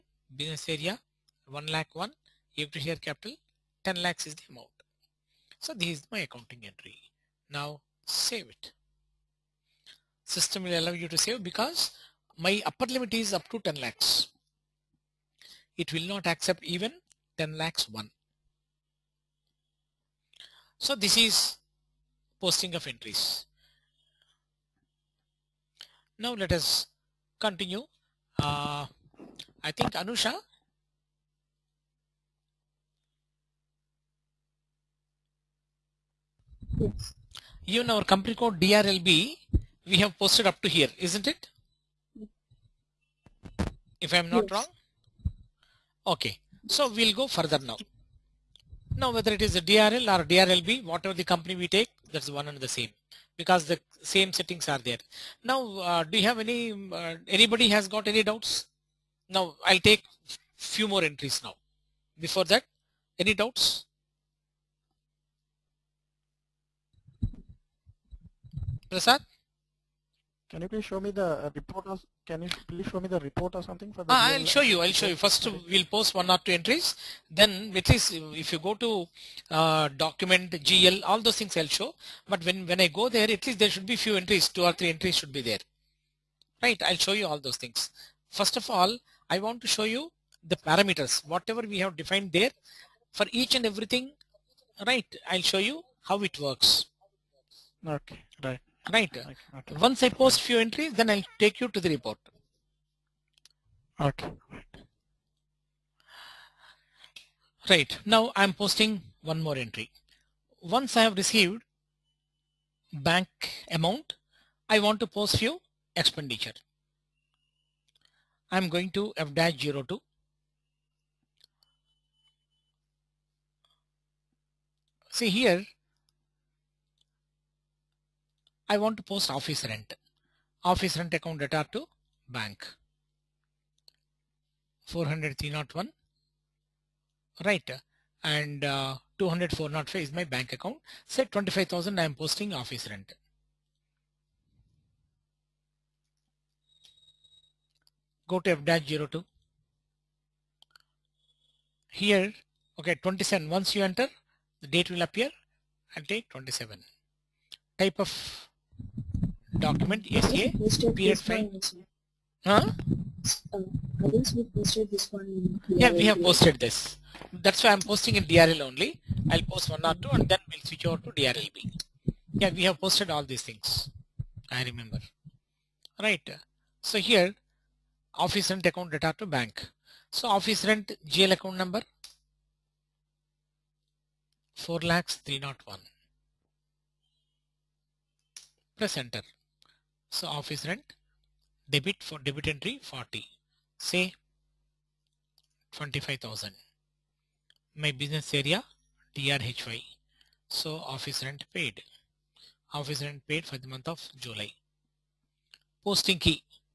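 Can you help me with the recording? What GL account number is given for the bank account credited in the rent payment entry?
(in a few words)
200405.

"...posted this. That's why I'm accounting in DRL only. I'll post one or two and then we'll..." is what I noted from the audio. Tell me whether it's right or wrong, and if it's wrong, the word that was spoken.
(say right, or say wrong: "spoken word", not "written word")
wrong: "posting", not "accounting".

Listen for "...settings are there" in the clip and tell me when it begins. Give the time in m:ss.
0:54.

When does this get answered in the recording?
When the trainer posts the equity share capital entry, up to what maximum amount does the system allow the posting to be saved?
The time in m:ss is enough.
0:12.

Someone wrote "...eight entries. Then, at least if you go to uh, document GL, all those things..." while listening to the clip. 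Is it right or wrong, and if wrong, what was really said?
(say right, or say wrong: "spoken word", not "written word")
wrong: "two", not "eight".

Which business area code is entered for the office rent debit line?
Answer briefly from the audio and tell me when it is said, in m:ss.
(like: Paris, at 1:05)
DRHY, at 3:19.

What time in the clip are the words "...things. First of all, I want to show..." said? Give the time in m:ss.
1:27.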